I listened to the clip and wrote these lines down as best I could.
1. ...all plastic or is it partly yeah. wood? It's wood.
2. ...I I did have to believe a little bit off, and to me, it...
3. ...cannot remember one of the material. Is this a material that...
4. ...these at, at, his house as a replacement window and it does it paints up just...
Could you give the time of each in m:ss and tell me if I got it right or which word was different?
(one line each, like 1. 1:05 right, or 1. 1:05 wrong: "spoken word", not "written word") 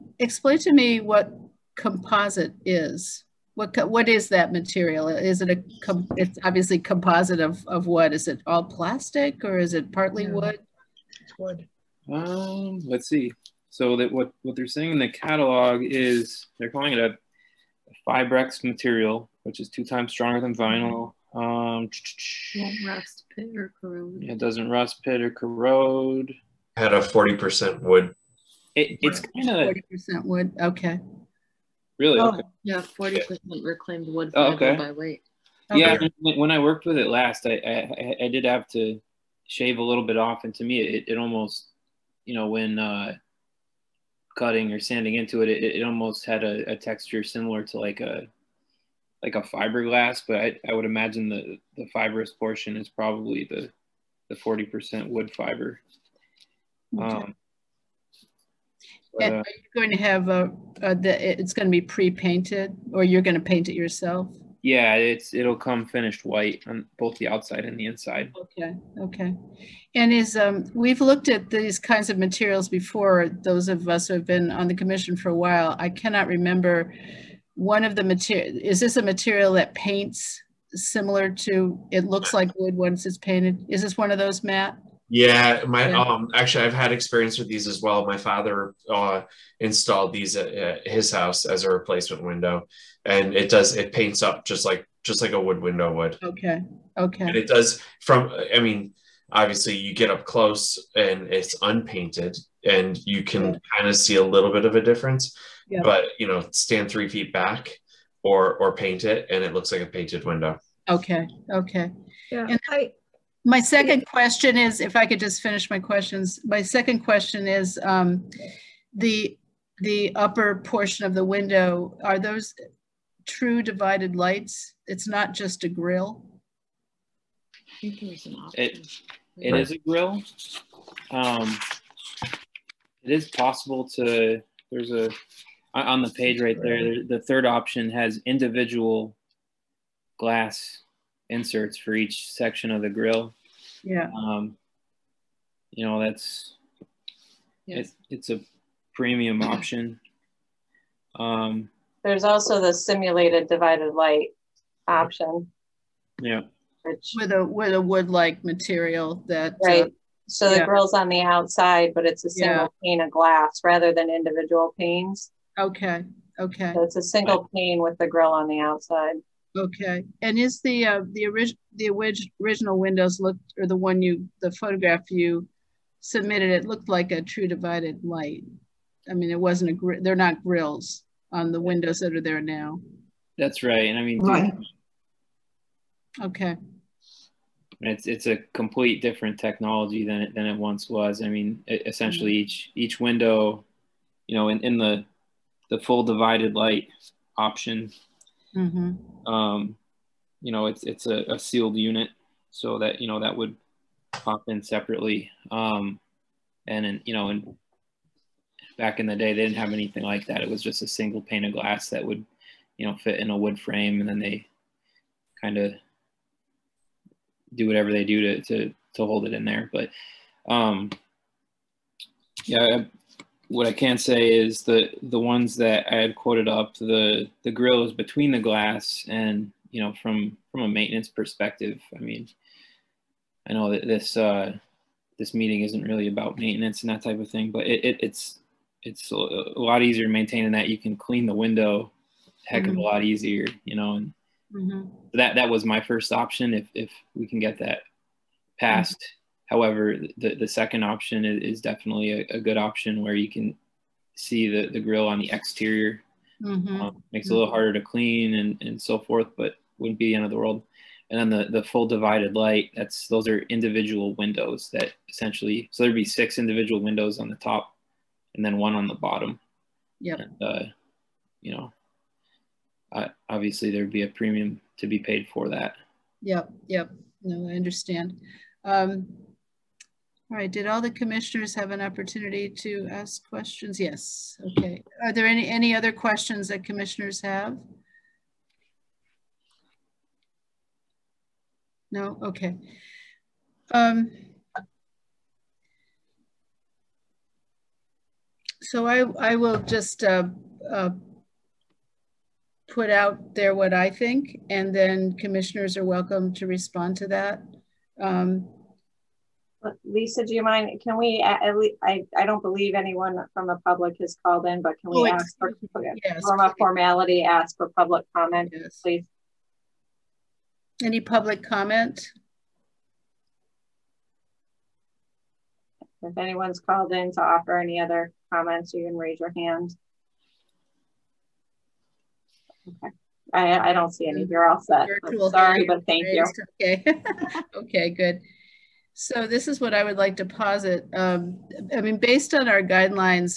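1. 0:08 right
2. 0:37 wrong: "shave", not "believe"
3. 1:15 right
4. 1:30 right.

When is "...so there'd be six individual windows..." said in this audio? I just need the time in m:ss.
4:25.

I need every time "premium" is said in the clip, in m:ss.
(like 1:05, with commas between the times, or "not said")
2:28, 4:34.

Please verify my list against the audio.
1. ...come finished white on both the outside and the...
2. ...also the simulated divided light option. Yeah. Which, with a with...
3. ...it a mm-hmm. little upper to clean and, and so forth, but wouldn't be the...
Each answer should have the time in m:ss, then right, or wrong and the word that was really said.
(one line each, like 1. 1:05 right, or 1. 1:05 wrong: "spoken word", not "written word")
1. 1:05 right
2. 2:32 right
3. 4:17 wrong: "harder", not "upper".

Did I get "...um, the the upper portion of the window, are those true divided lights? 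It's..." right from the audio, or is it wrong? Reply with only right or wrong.
right.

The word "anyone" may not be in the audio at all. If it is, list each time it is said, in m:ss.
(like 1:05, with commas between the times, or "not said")
5:12, 5:26.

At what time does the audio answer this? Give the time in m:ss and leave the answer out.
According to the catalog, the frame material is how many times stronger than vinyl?
0:19.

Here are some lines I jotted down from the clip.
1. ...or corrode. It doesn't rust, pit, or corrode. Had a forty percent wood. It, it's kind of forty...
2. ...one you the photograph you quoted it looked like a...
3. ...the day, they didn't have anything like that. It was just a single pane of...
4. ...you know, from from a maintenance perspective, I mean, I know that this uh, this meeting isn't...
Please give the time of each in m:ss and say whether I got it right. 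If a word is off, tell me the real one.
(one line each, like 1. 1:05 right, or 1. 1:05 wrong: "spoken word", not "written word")
1. 0:23 right
2. 2:53 wrong: "submitted", not "quoted"
3. 3:29 right
4. 3:49 right.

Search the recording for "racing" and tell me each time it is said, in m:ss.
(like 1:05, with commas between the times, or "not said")
not said.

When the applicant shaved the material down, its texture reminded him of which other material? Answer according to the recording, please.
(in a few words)
Fiberglass.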